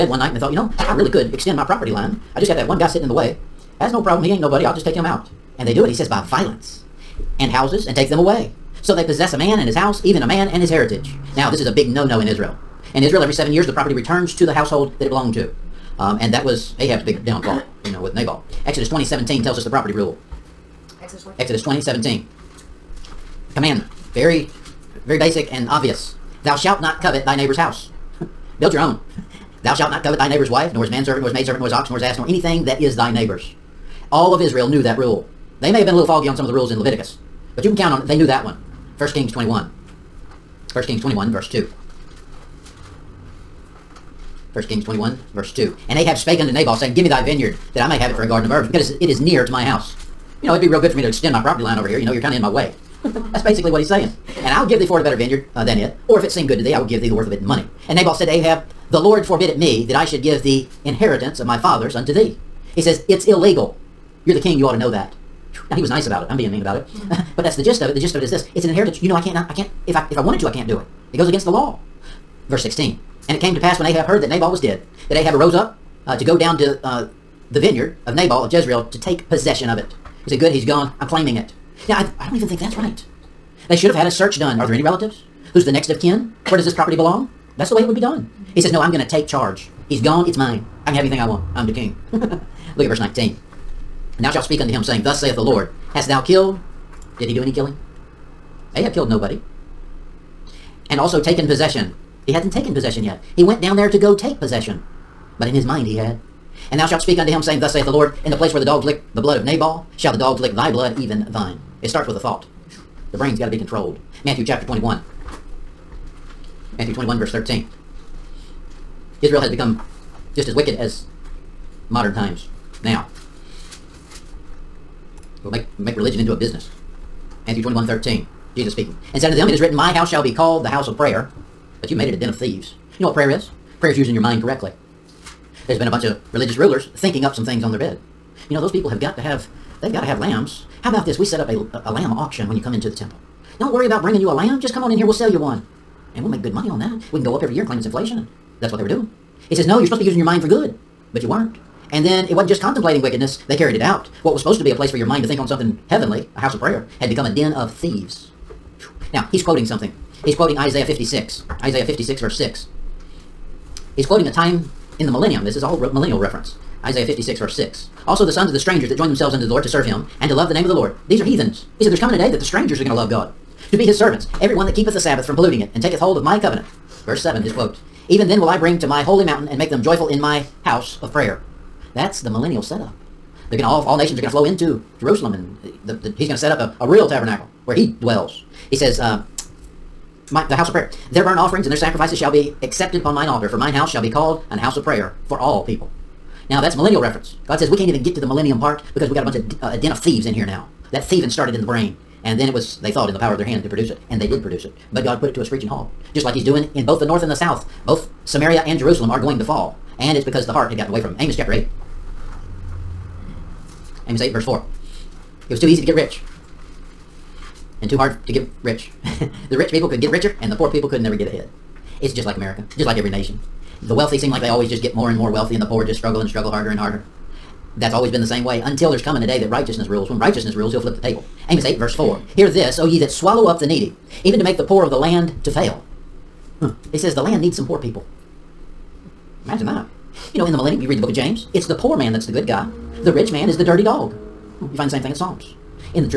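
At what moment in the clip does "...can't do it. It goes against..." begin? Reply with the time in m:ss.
1:10.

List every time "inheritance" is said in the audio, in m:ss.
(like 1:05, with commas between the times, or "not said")
1:00, 1:08.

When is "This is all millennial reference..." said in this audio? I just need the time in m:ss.
2:45.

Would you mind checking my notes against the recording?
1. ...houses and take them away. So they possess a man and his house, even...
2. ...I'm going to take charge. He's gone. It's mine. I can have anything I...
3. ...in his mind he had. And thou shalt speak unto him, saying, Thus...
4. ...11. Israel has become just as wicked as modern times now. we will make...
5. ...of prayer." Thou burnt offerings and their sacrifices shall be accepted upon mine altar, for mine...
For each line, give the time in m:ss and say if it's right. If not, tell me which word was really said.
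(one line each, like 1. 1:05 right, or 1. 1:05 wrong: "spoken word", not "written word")
1. 0:07 right
2. 1:28 right
3. 1:45 right
4. 1:57 wrong: "13", not "11"
5. 3:10 wrong: "Their", not "Thou".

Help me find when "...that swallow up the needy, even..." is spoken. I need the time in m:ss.
3:52.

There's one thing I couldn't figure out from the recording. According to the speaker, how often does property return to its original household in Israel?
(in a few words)
every 7 years.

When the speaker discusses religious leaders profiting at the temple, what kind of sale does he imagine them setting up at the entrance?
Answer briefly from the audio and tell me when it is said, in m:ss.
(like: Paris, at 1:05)
lamb auction, at 2:21.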